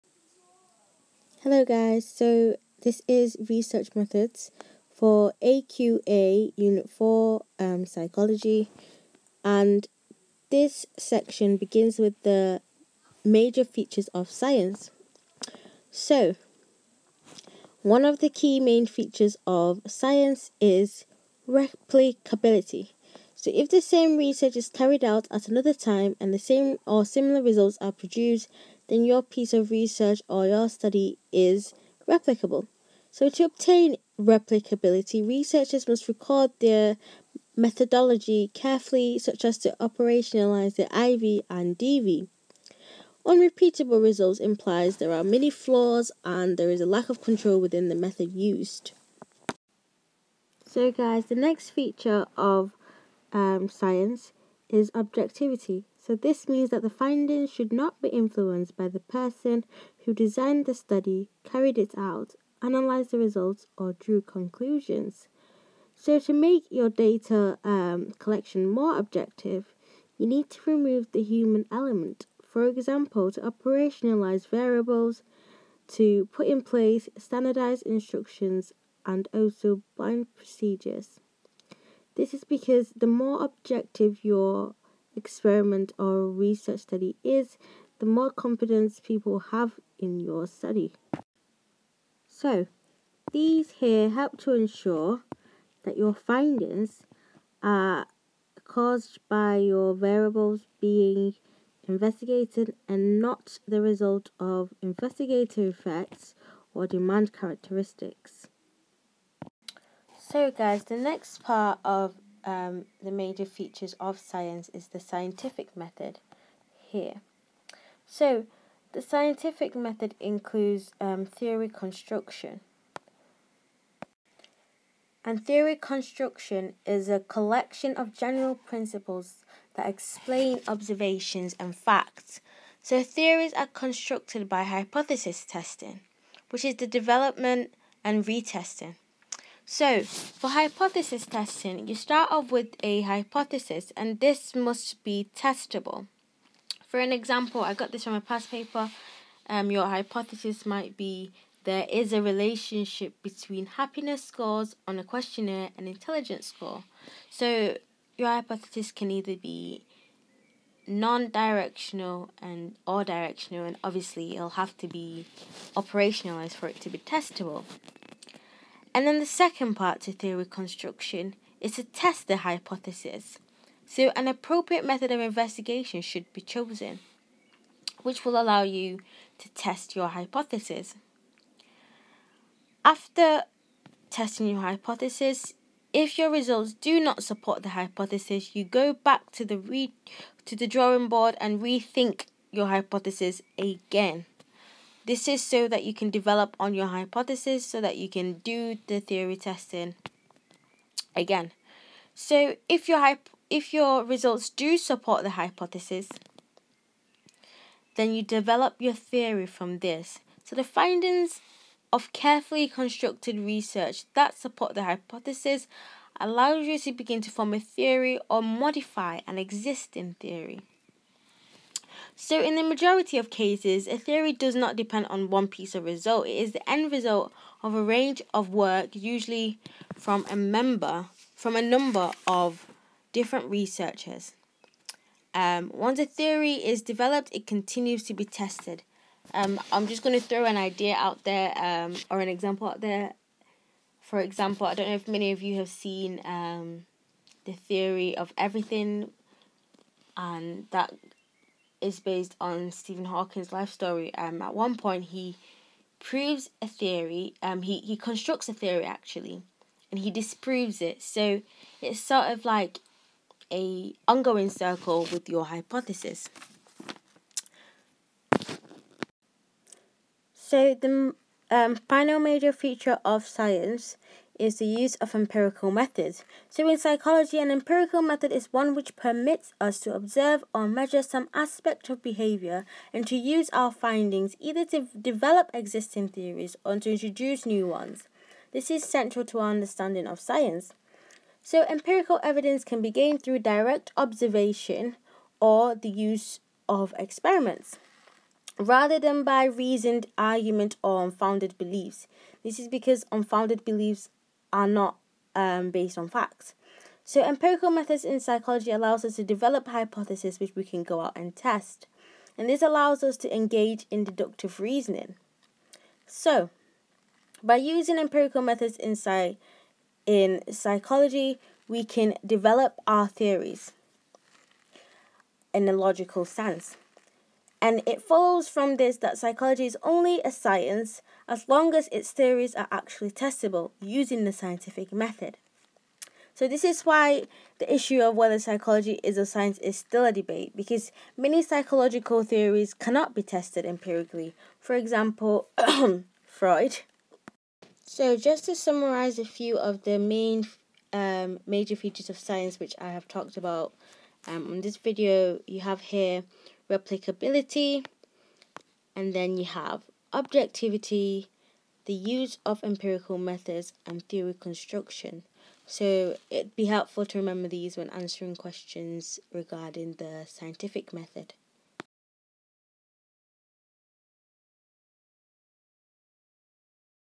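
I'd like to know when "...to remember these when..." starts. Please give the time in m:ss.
6:07.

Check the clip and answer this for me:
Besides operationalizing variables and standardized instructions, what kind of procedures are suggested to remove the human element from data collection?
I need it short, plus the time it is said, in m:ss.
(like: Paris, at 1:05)
Blind procedures, at 1:19.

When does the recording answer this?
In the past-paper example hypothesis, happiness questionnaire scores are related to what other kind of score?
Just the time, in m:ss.
2:35.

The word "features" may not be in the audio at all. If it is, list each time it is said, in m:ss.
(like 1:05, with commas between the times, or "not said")
0:13, 0:18, 0:51, 1:53, 4:32, 5:51.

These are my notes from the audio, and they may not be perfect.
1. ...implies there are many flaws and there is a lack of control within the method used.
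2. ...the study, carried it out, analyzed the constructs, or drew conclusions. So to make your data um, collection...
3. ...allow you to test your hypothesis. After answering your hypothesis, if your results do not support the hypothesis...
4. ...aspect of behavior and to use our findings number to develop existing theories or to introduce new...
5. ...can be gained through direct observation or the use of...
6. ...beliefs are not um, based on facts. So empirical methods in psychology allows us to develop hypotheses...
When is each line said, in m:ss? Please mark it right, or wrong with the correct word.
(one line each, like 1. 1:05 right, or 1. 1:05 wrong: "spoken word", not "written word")
1. 0:44 right
2. 1:00 wrong: "results", not "constructs"
3. 2:58 wrong: "testing", not "answering"
4. 4:41 wrong: "either", not "number"
5. 4:52 right
6. 5:03 right.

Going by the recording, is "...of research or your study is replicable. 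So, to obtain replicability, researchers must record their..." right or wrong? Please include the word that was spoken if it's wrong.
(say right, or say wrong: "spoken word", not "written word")
right.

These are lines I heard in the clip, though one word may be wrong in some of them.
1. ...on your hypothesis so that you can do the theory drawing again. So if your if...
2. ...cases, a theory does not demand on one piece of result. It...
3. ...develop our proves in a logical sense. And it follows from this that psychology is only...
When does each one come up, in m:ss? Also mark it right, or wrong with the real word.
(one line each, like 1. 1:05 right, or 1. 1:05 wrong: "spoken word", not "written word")
1. 3:16 wrong: "testing", not "drawing"
2. 3:43 wrong: "depend", not "demand"
3. 5:22 wrong: "theories", not "proves".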